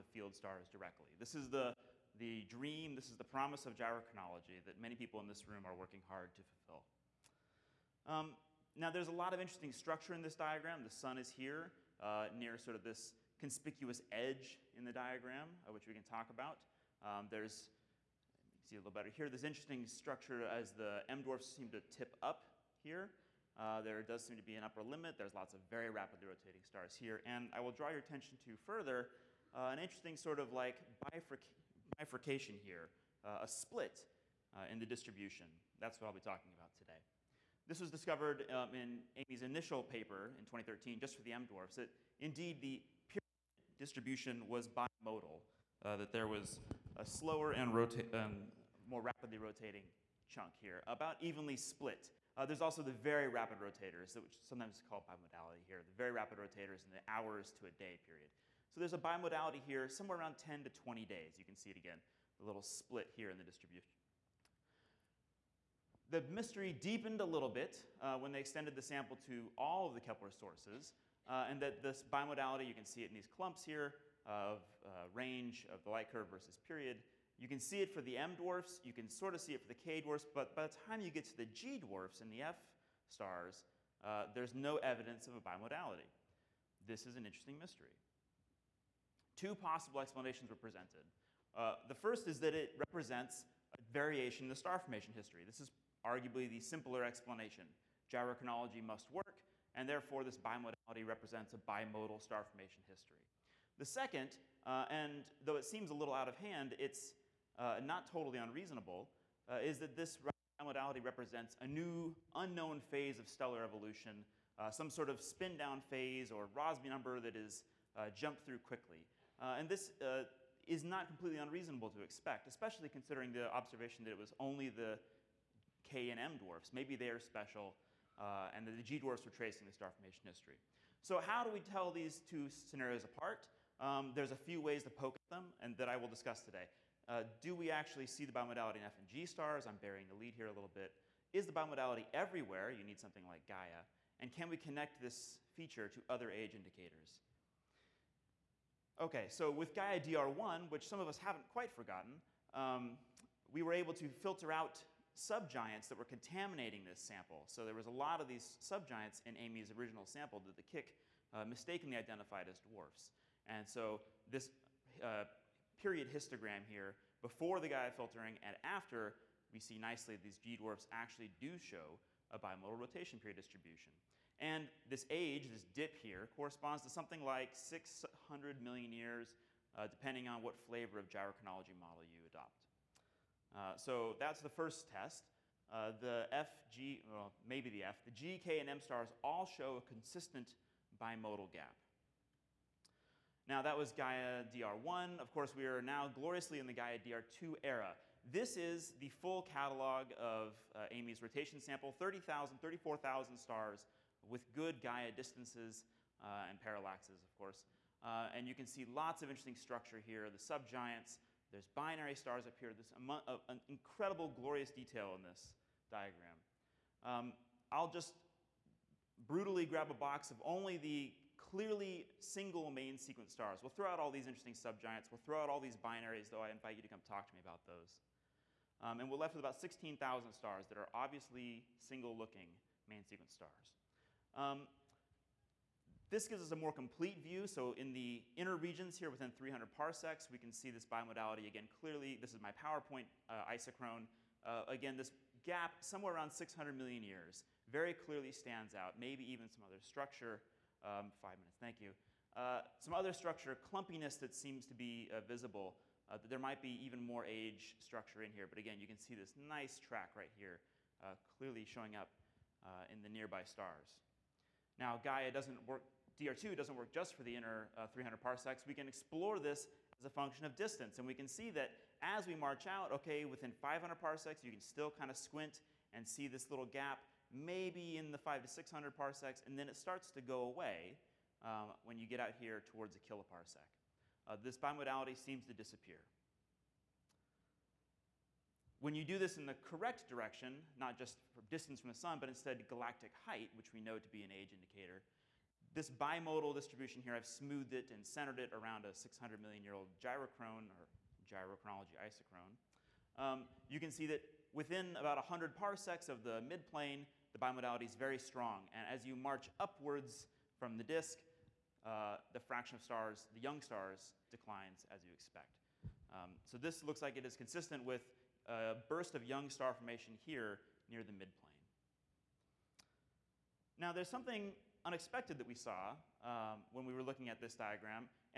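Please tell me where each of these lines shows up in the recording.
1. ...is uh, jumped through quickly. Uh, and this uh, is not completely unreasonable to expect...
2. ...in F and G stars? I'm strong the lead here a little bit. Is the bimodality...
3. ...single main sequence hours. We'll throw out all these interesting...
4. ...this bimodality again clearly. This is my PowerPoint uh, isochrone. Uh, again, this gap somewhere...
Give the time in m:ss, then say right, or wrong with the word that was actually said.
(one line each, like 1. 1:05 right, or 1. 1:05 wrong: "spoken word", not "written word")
1. 1:57 right
2. 2:18 wrong: "burying", not "strong"
3. 3:42 wrong: "stars", not "hours"
4. 4:00 right.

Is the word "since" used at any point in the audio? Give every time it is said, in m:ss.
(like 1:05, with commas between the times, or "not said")
not said.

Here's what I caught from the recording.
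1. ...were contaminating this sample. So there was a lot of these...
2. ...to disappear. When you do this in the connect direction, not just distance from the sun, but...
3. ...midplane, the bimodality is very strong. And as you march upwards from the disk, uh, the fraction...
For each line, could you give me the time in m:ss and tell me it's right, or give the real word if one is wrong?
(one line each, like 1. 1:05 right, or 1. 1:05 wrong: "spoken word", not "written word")
1. 2:35 right
2. 4:45 wrong: "correct", not "connect"
3. 5:06 right.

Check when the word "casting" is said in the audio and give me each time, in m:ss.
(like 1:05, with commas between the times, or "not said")
not said.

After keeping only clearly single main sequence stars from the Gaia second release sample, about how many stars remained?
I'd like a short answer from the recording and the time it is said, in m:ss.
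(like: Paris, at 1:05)
16,000, at 3:49.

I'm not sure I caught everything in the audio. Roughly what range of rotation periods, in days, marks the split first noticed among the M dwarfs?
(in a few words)
10 to 20 days.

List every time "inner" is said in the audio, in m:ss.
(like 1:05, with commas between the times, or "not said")
3:58, 4:27.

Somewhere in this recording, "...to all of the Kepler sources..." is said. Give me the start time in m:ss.
1:09.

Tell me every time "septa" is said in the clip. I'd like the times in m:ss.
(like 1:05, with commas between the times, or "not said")
not said.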